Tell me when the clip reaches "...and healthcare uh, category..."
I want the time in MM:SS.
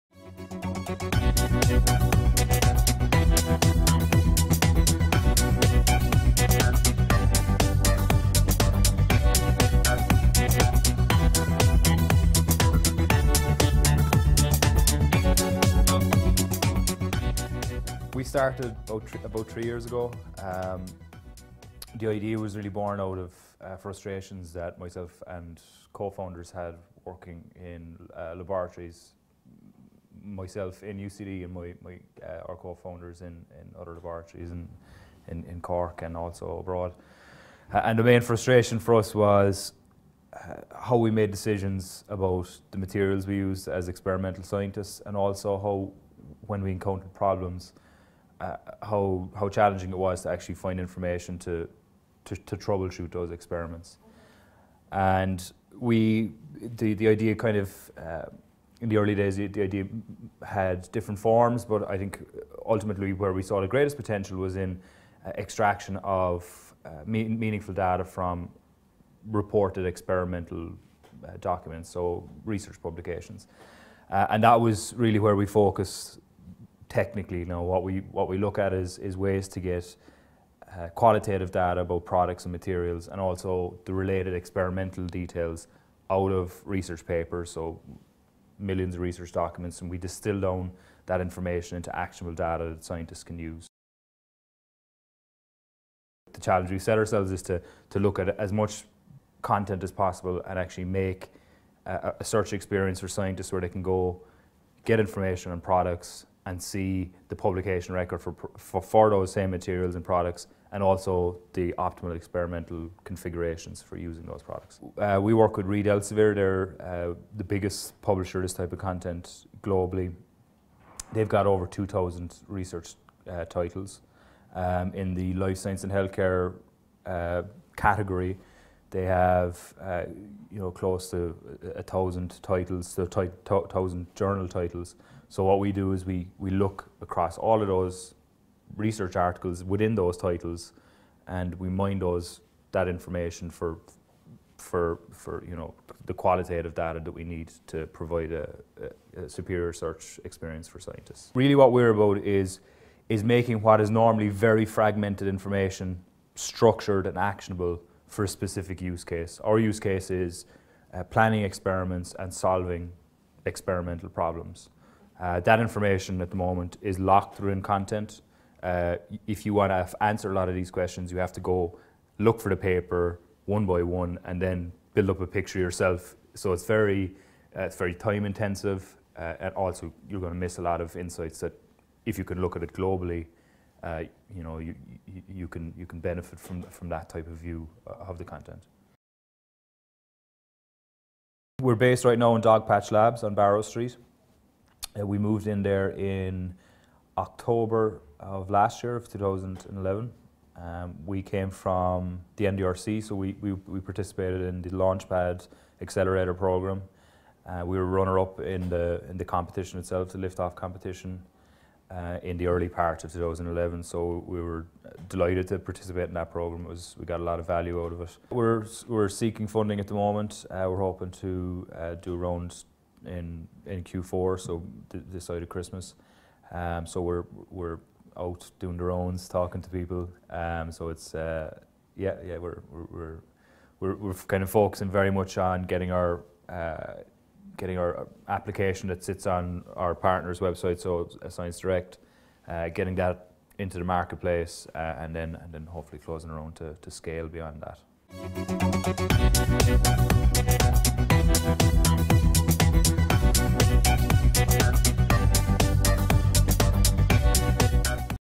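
02:05.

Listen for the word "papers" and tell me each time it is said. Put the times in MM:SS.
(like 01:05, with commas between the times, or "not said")
01:27, 02:52.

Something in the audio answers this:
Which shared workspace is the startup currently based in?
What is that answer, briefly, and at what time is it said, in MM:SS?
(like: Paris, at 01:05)
Dogpatch Labs, at 03:12.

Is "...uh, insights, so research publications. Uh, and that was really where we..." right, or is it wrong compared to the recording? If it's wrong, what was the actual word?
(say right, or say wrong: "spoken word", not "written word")
wrong: "documents", not "insights".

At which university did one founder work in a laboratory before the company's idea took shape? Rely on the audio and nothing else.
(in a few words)
UCD.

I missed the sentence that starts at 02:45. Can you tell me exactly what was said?
Uh, that information at the moment is locked within content.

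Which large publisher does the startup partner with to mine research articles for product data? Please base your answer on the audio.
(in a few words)
Reed Elsevier.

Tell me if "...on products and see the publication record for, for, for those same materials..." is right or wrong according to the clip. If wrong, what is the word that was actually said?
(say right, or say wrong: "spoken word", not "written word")
right.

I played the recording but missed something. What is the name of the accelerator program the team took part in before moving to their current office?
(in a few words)
Launchpad.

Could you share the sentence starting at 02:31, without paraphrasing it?
Really, what we're about is is making what is normally very fragmented information structured and actionable for a specific use case.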